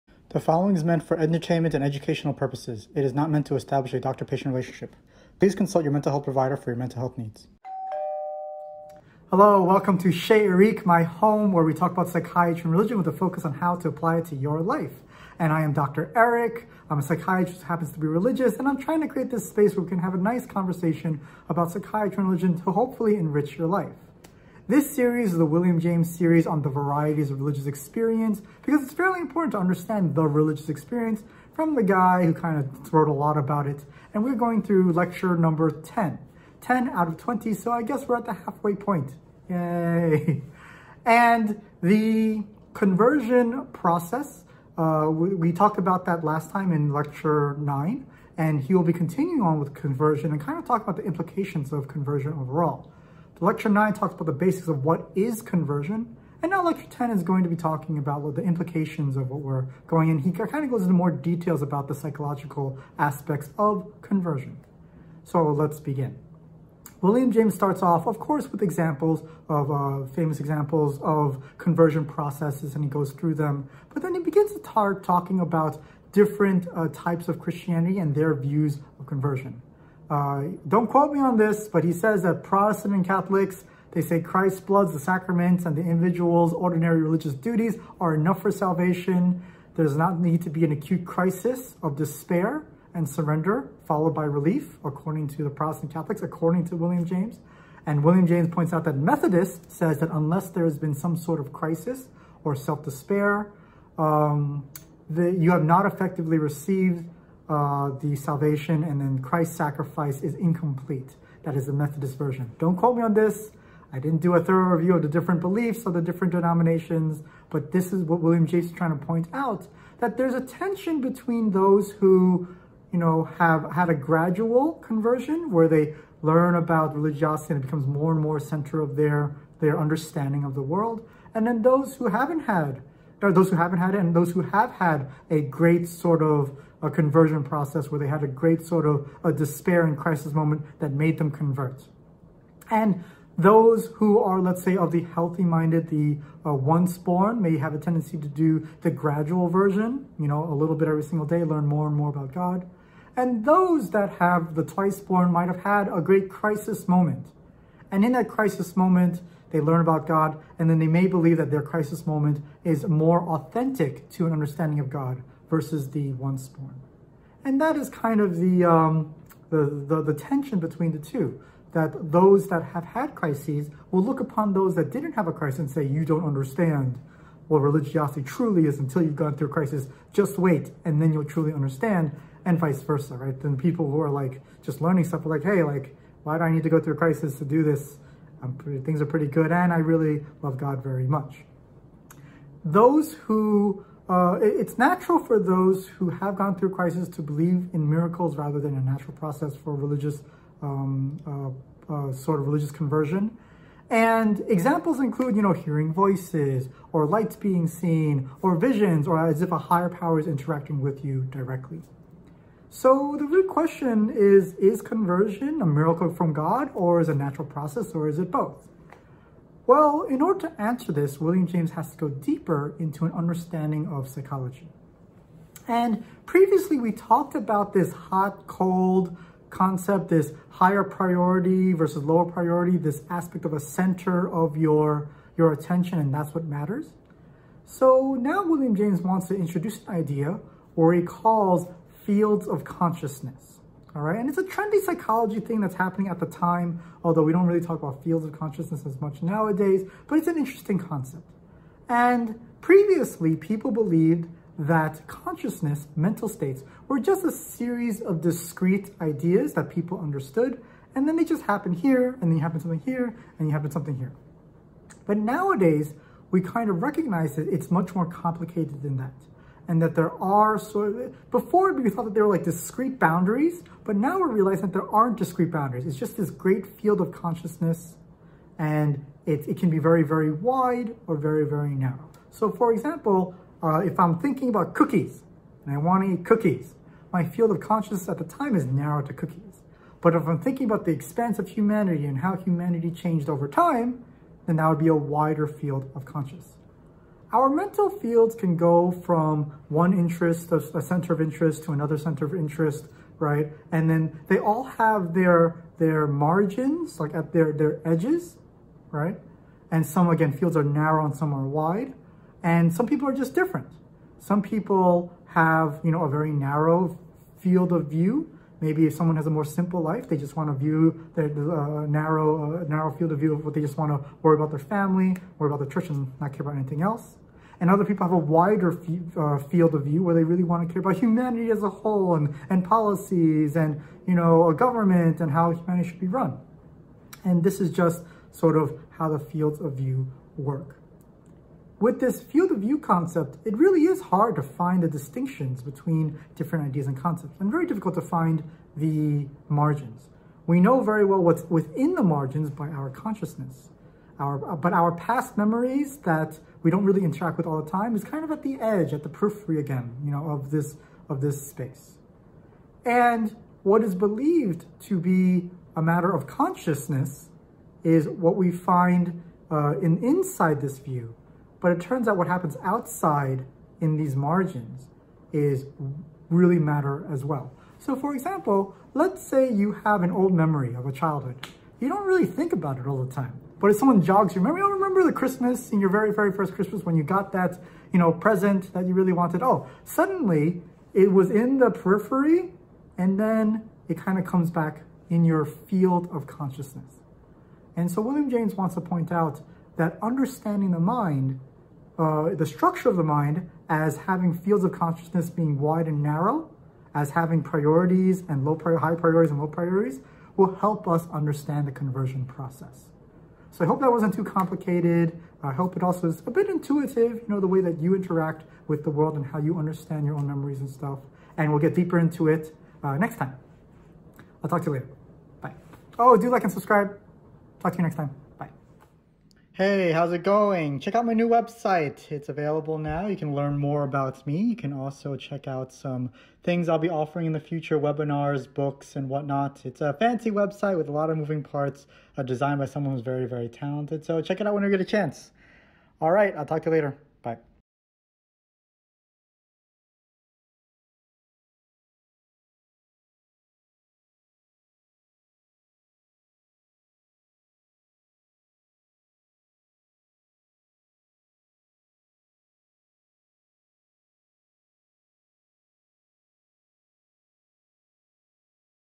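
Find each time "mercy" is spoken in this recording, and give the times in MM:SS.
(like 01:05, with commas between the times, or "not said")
not said.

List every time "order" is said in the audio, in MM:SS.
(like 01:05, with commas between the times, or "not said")
03:40.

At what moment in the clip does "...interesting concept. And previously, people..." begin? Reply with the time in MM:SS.
04:10.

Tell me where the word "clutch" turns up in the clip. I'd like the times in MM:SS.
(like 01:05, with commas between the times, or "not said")
not said.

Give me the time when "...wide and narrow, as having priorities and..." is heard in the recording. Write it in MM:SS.
06:45.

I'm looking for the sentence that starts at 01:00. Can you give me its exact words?
He kind of goes into more details about the psychological aspects of conversion.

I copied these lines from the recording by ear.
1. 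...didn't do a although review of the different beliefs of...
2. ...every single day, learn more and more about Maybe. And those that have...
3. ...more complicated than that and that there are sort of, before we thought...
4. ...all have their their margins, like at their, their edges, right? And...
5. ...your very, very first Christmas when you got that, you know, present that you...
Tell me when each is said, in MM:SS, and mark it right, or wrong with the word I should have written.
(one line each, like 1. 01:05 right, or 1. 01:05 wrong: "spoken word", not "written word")
1. 01:53 wrong: "thorough", not "although"
2. 02:30 wrong: "God", not "Maybe"
3. 04:27 right
4. 05:04 right
5. 06:25 right.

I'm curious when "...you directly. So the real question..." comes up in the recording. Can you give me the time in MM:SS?
03:31.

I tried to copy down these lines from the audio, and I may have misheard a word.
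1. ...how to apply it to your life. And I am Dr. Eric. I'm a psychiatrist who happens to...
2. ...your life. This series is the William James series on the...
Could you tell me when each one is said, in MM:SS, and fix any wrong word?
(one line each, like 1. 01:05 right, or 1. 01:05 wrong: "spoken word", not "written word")
1. 00:13 right
2. 00:23 right.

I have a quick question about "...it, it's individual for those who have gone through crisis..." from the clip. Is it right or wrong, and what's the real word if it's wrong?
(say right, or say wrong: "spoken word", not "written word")
wrong: "natural", not "individual".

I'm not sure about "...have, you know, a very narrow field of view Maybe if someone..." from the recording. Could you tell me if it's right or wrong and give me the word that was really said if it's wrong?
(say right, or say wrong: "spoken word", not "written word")
right.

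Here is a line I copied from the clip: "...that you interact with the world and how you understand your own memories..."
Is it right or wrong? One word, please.
right.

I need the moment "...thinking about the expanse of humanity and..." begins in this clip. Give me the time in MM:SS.
04:50.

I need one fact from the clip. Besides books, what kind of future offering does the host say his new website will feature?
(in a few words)
webinars.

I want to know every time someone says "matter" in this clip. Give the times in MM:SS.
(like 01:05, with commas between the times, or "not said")
03:56, 06:05, 06:16.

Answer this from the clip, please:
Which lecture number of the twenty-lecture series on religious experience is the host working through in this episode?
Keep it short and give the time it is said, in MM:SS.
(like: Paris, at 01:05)
10, at 00:34.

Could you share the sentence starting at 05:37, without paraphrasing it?
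And this is just sort of how the fields of view work.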